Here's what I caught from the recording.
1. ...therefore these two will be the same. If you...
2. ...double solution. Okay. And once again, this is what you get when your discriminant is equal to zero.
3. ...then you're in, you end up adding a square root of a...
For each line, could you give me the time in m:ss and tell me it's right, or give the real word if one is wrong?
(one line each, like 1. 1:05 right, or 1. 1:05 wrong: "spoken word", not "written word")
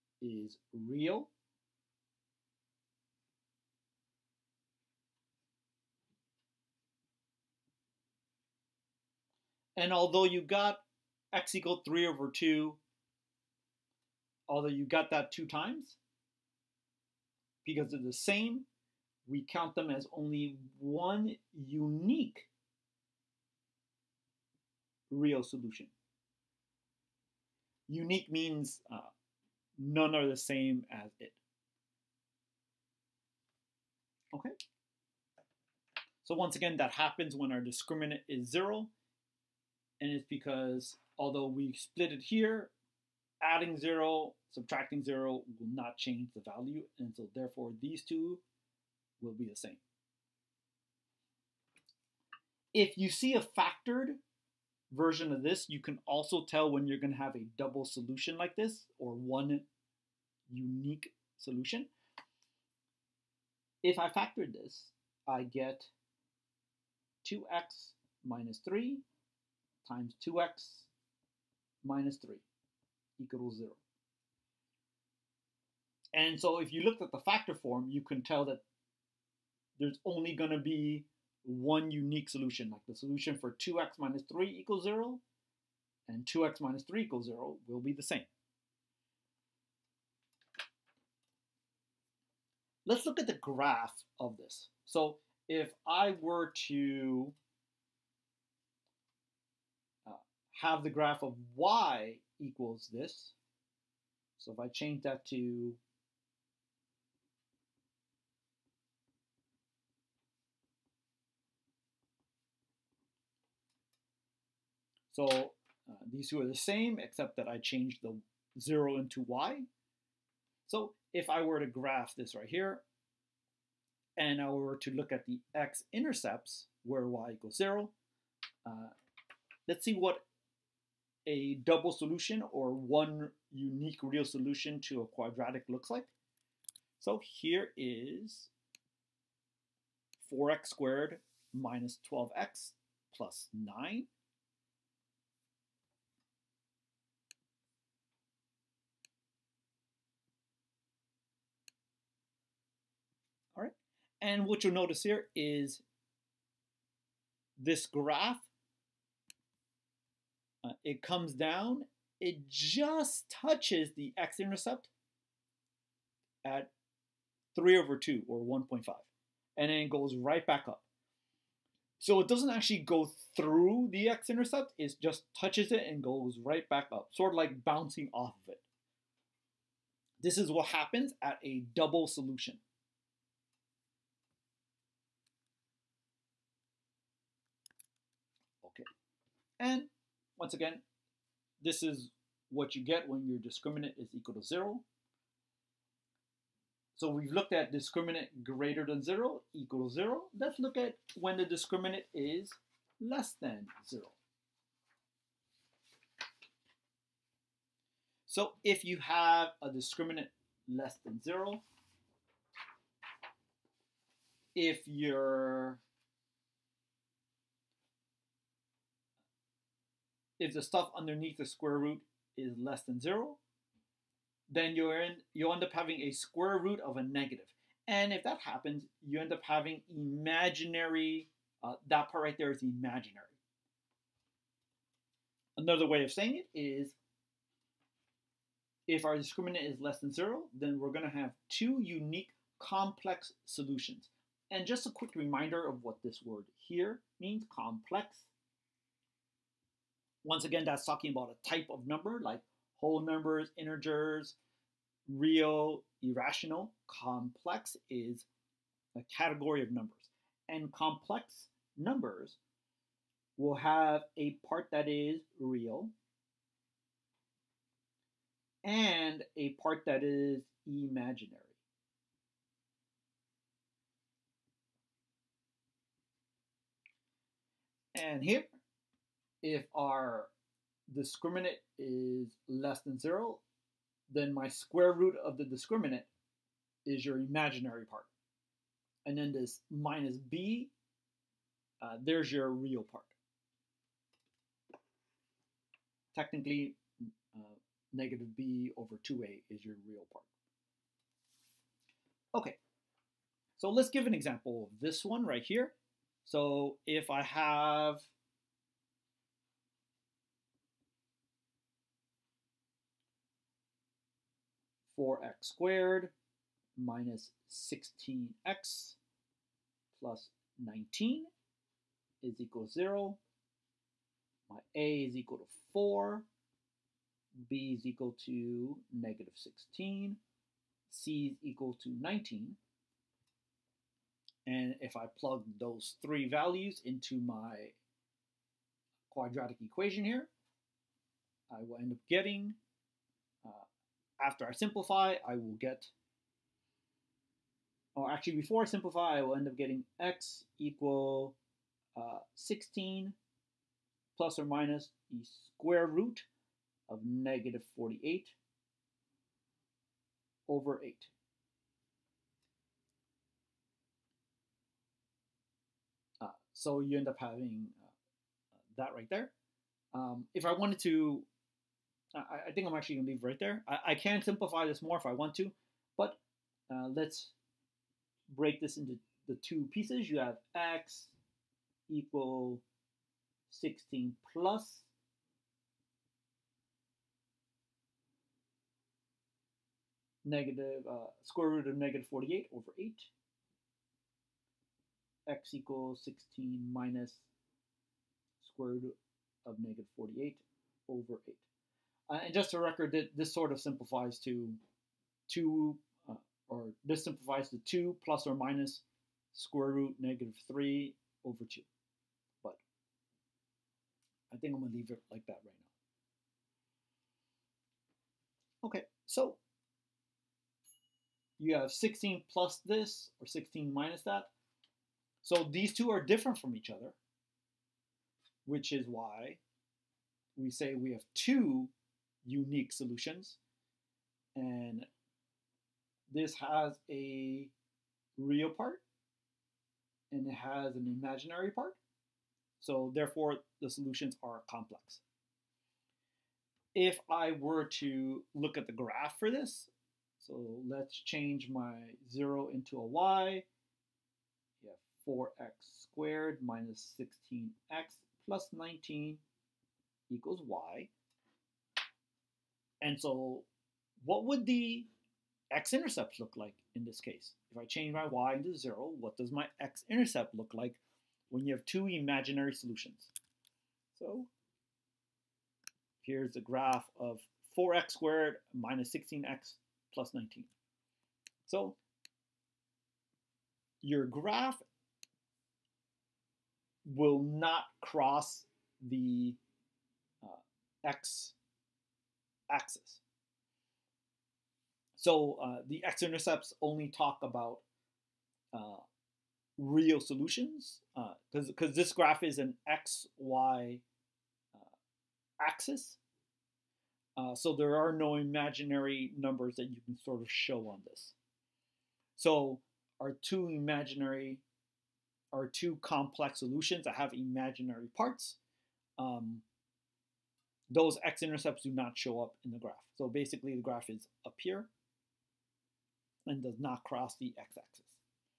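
1. 0:47 right
2. 3:01 right
3. 3:44 wrong: "having", not "adding".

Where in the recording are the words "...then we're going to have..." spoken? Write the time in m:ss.
4:00.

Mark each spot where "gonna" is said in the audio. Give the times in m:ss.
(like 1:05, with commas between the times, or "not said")
0:56, 6:54.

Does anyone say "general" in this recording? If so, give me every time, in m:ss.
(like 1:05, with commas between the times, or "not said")
not said.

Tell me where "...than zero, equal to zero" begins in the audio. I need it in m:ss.
3:18.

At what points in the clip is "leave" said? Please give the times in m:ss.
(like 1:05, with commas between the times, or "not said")
6:13, 6:54.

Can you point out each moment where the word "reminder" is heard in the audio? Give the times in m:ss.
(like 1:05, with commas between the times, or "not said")
4:05.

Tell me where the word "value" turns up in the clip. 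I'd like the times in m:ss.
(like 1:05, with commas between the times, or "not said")
0:46, 5:36.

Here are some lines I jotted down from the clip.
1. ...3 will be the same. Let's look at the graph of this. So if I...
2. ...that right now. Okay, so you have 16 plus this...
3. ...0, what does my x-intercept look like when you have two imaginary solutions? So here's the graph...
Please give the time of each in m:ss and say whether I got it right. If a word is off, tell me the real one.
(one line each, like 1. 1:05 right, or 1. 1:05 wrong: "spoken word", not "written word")
1. 1:27 wrong: "0", not "3"
2. 6:55 right
3. 7:48 right.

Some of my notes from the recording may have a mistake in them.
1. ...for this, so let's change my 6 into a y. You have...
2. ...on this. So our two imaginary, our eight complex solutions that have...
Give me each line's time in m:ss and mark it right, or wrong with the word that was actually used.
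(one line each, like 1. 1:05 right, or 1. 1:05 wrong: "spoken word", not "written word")
1. 7:29 wrong: "0", not "6"
2. 8:30 wrong: "two", not "eight".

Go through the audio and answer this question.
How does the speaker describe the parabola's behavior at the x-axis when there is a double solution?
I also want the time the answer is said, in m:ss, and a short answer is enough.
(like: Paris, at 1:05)
Bouncing off, at 2:57.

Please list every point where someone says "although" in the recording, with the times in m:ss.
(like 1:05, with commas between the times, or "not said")
0:09, 0:14, 0:41.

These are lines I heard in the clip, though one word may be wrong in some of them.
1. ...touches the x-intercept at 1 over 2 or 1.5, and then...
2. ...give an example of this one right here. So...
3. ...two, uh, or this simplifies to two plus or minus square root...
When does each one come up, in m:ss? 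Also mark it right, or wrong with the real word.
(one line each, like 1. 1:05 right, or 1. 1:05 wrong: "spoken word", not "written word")
1. 2:43 wrong: "3", not "1"
2. 5:03 right
3. 6:45 right.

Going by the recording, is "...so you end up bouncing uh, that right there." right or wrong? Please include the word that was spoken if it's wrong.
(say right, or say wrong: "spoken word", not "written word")
wrong: "having", not "bouncing".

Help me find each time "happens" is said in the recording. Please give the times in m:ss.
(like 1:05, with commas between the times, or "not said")
0:36, 3:00, 3:48.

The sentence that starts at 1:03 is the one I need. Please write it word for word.
If I factored this, I get 2x minus 3 times 2x minus 3 equals 0.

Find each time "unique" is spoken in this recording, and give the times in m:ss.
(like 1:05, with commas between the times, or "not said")
0:21, 0:27, 1:00, 1:21, 2:13, 4:01, 7:12.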